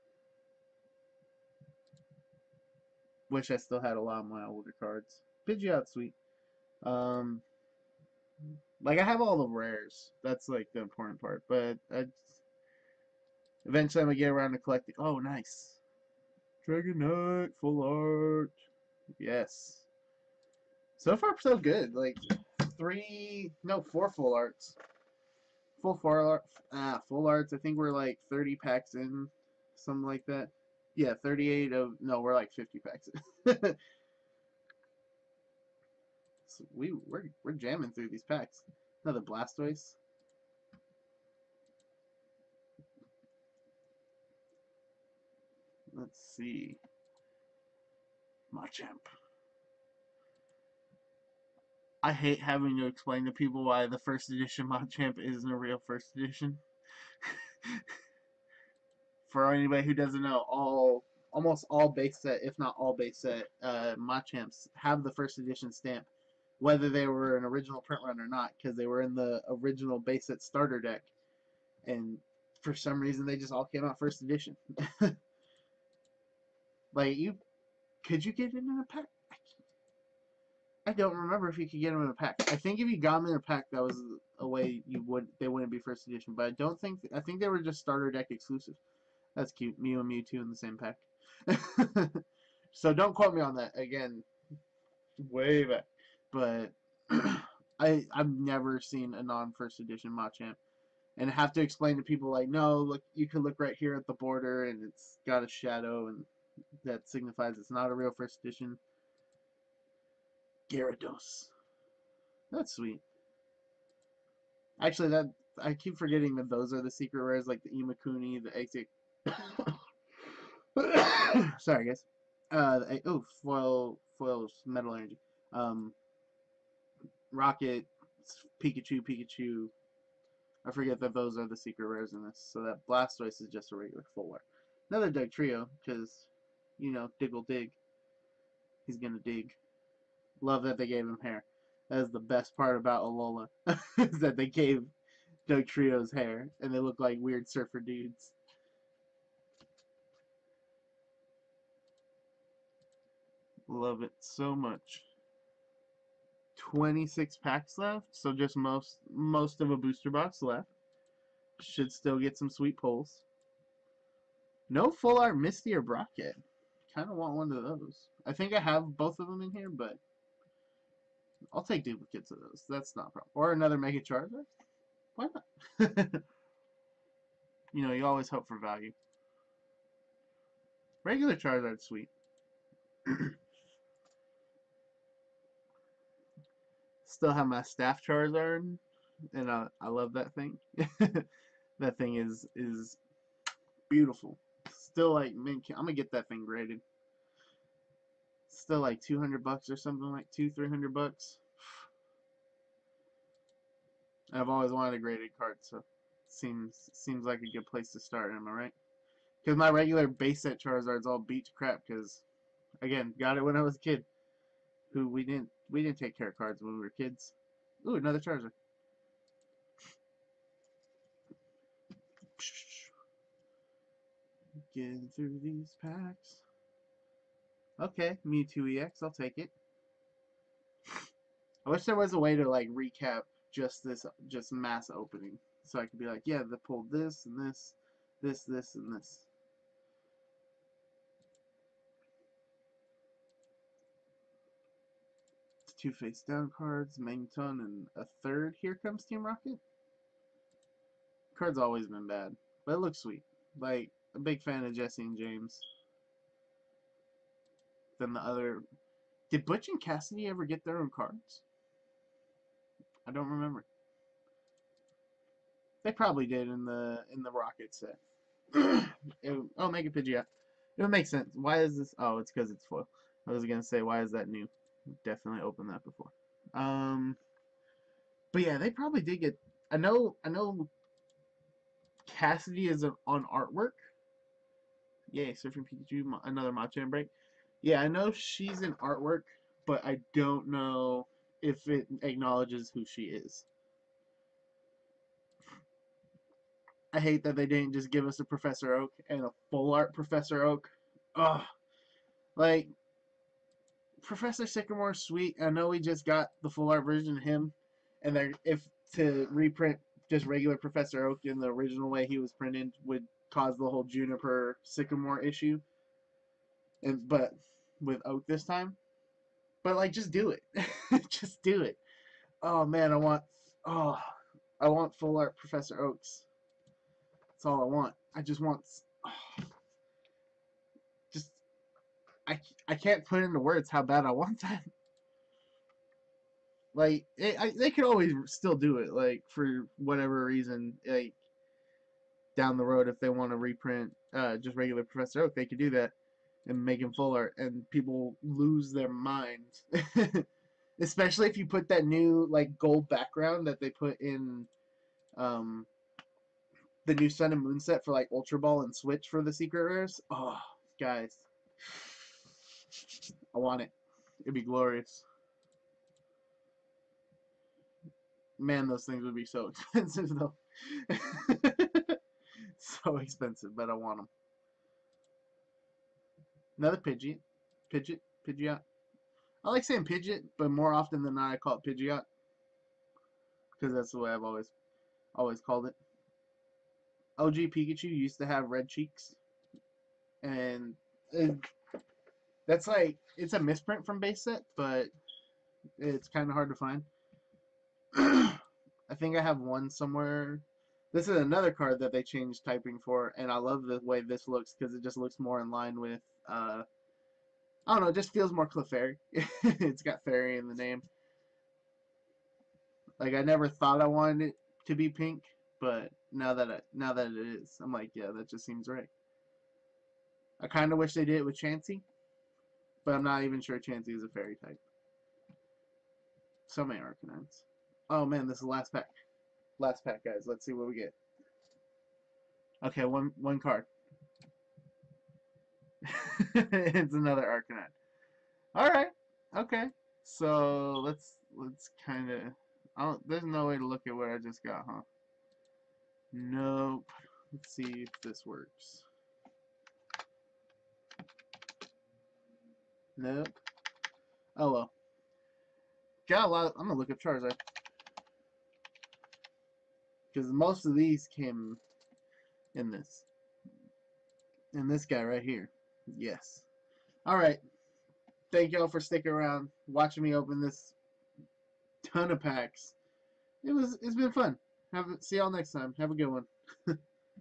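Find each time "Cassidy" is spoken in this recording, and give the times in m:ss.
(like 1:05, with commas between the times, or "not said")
4:19, 4:42.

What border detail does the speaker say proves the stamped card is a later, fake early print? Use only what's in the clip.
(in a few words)
A shadow.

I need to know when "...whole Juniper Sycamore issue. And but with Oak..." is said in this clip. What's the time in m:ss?
5:13.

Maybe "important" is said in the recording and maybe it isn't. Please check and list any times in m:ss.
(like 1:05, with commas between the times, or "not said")
0:10.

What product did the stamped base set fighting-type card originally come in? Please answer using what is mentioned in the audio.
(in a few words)
Base set starter deck.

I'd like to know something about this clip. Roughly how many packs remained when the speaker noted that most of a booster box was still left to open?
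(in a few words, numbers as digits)
26.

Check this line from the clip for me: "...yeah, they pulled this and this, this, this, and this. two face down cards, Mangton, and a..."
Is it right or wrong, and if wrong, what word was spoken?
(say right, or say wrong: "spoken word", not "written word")
right.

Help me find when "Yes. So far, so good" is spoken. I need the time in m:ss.
0:19.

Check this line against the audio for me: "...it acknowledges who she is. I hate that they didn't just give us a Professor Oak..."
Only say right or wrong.
right.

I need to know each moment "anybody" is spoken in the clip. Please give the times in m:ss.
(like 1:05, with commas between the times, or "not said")
0:59.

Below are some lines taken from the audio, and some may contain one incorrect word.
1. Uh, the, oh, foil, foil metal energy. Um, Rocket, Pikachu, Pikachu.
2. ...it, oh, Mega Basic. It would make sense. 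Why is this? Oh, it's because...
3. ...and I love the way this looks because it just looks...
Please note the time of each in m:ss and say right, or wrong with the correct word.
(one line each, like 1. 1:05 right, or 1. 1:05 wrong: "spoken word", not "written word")
1. 2:02 right
2. 4:28 wrong: "Pidgeot", not "Basic"
3. 6:43 right.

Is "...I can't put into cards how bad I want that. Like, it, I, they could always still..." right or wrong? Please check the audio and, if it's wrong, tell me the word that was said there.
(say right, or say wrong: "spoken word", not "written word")
wrong: "words", not "cards".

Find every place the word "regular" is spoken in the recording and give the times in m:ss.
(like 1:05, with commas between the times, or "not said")
2:13, 3:01, 3:29, 5:10, 5:44.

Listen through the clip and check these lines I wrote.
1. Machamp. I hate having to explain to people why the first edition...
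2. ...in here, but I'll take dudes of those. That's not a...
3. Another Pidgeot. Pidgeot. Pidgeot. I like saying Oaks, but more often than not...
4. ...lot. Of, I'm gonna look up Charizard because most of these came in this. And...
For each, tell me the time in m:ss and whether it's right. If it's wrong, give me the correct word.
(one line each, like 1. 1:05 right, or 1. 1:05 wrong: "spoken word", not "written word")
1. 0:48 right
2. 2:49 wrong: "duplicates", not "dudes"
3. 6:16 wrong: "Pidgeot", not "Oaks"
4. 7:36 right.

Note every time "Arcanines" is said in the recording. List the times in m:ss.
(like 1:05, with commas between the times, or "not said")
7:06, 7:17.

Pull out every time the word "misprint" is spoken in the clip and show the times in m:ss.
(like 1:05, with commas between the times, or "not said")
6:33.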